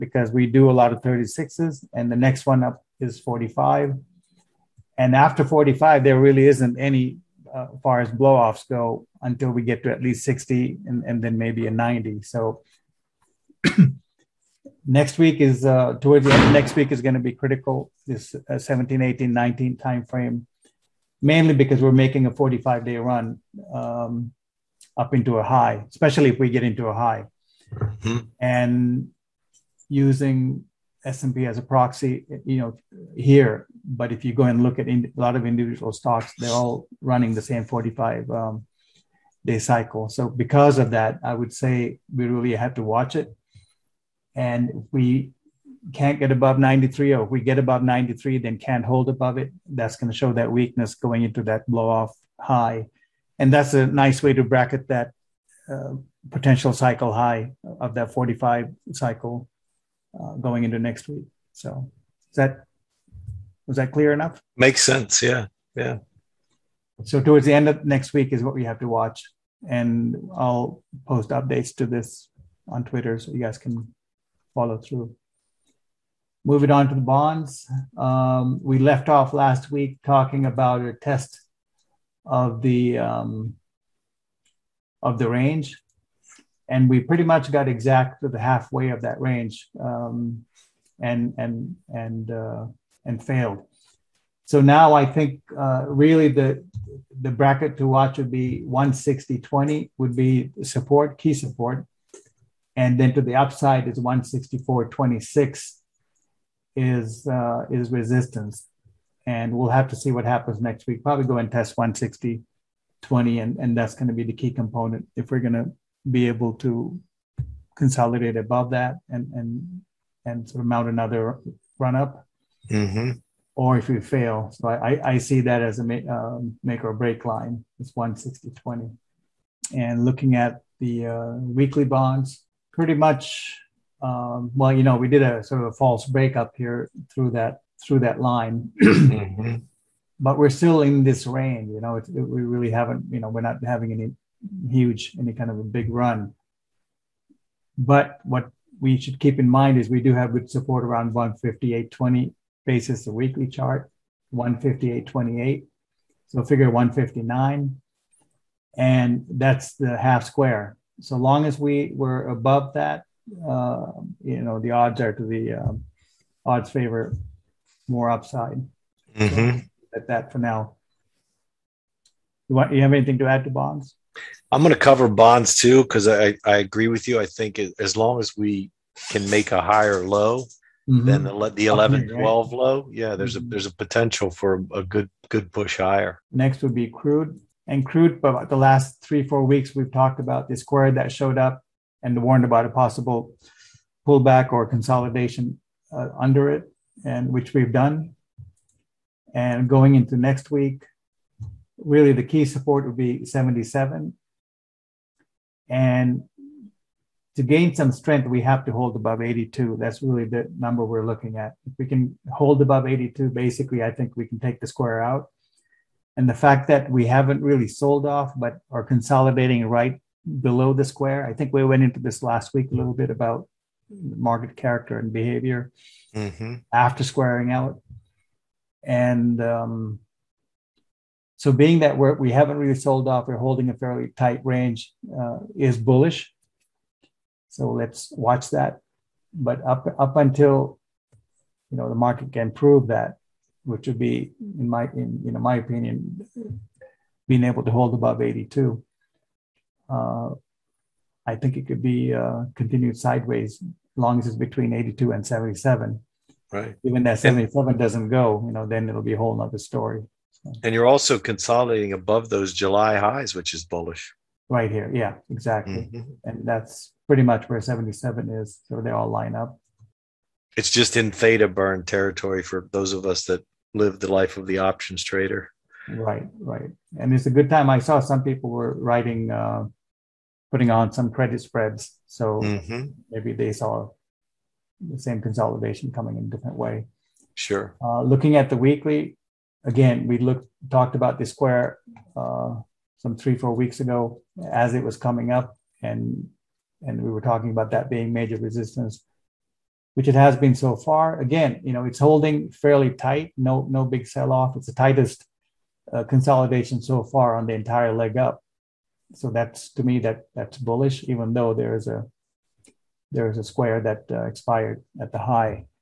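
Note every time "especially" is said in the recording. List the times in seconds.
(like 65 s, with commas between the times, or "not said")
25 s.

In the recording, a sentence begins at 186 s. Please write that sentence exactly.
Next would be crude and crude.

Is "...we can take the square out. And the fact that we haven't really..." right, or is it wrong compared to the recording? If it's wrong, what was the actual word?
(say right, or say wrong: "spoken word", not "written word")
right.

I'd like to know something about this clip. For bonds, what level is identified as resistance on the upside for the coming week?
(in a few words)
164 26.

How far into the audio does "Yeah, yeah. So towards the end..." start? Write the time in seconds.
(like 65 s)
65 s.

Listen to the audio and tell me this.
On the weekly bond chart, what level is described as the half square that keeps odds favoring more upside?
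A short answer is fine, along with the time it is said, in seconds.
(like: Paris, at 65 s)
159, at 156 s.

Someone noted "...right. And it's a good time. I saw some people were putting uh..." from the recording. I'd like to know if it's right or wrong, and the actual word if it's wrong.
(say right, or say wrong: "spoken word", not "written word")
wrong: "writing", not "putting".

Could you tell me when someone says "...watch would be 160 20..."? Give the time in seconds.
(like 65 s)
97 s.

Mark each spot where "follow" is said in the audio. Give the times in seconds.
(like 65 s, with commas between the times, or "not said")
74 s.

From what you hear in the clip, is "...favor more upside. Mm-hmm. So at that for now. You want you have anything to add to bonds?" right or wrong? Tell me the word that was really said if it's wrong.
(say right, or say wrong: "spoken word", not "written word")
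right.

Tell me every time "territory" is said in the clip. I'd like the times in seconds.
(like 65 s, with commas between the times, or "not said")
271 s.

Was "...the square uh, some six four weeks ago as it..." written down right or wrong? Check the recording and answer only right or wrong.
wrong.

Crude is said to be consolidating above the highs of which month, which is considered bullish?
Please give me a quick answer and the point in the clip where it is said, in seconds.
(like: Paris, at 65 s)
July, at 262 s.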